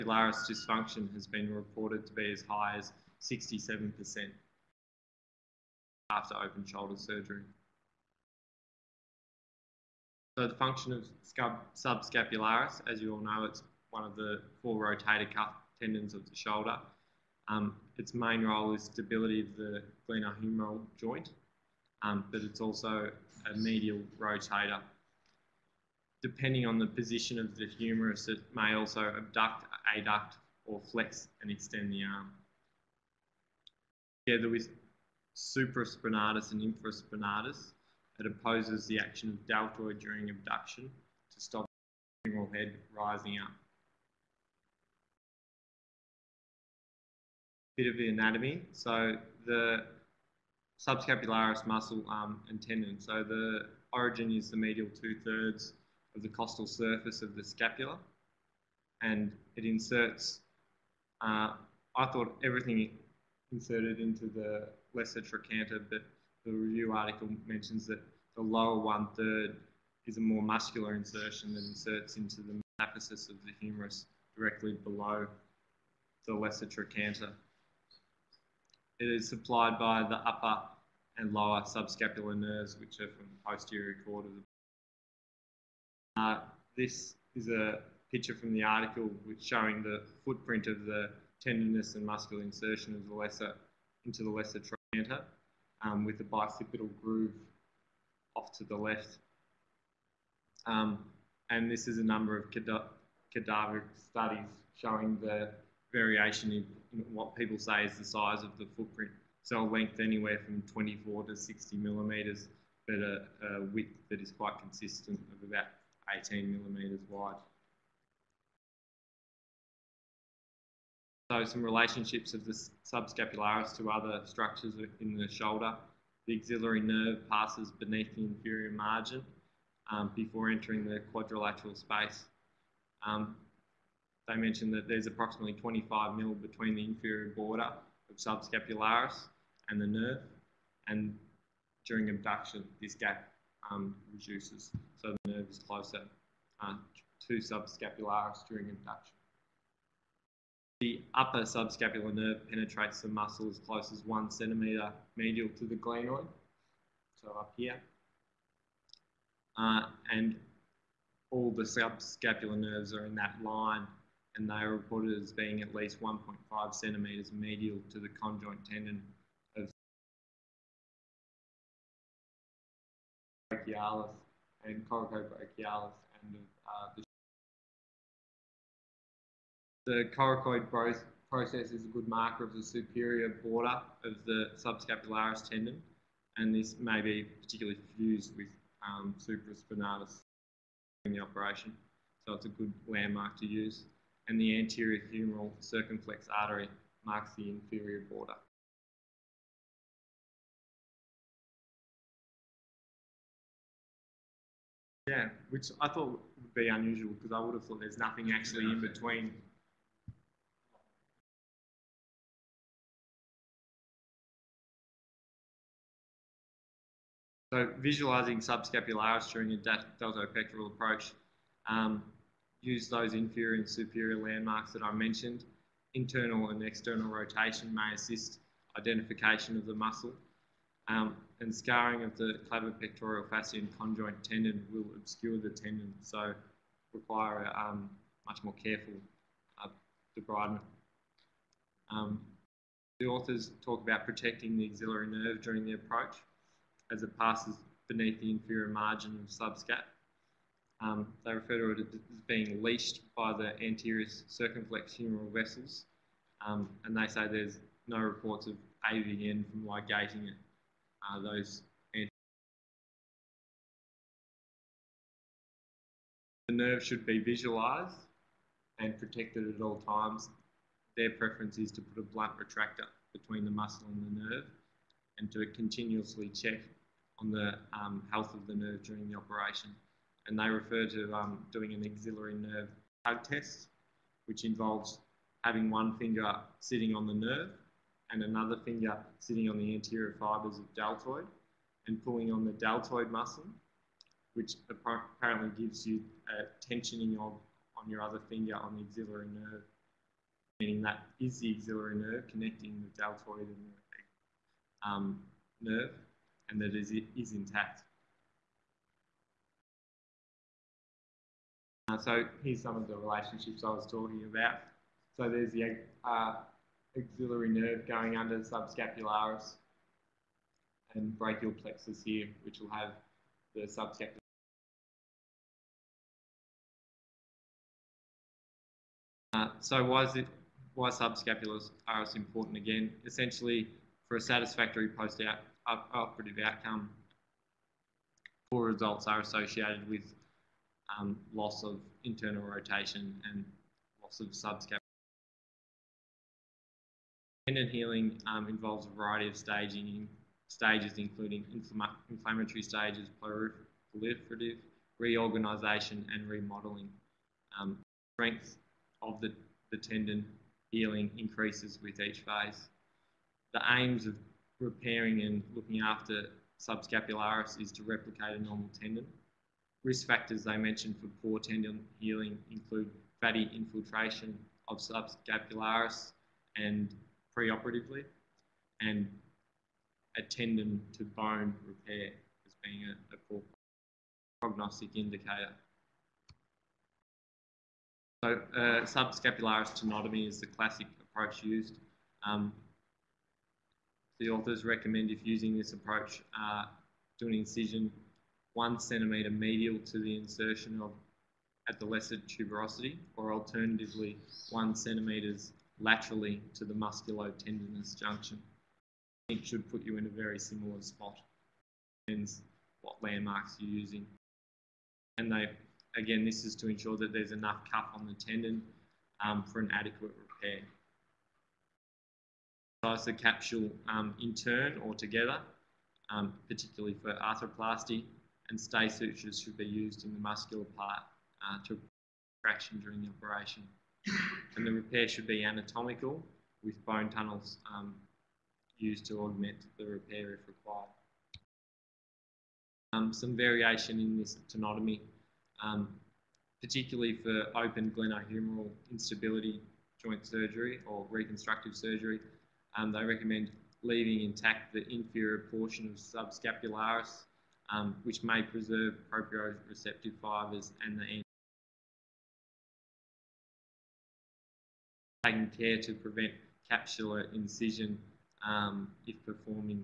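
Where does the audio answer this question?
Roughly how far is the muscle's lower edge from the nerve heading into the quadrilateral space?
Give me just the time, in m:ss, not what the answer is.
2:15.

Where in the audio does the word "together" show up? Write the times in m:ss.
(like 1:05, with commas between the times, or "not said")
0:34, 7:04.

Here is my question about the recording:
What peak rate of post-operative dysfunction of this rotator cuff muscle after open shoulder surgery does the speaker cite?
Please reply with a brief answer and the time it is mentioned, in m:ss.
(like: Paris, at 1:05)
67%, at 0:03.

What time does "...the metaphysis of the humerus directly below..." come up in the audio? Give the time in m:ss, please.
1:12.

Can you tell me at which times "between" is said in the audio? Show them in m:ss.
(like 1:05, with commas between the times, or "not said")
2:16, 3:28, 4:33.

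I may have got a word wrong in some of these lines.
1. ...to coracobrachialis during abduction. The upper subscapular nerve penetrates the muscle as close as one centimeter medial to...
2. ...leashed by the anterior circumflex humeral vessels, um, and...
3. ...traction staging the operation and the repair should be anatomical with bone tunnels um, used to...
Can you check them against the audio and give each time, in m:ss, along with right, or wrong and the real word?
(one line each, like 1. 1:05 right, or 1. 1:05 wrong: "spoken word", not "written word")
1. 2:27 wrong: "subscapularis", not "coracobrachialis"
2. 4:12 right
3. 7:12 wrong: "during", not "staging".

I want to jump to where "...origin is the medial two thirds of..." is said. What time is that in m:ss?
0:53.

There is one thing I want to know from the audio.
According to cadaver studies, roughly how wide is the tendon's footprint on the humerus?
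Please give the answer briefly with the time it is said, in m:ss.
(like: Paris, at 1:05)
18 millimeters, at 1:56.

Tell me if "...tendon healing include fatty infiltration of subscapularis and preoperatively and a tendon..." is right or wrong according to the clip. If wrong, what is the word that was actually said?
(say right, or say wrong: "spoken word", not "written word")
right.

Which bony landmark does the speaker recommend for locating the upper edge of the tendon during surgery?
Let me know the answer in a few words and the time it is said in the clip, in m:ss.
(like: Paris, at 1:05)
coracoid process, at 3:00.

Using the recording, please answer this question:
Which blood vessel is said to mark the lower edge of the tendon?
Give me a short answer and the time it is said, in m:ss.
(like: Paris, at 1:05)
anterior humeral circumflex artery, at 3:14.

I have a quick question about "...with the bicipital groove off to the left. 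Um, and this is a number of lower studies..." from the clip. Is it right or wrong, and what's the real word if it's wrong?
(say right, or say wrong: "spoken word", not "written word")
wrong: "cadaver", not "lower".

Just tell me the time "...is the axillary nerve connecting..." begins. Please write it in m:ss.
5:01.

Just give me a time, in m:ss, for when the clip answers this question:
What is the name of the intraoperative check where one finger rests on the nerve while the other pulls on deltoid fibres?
4:41.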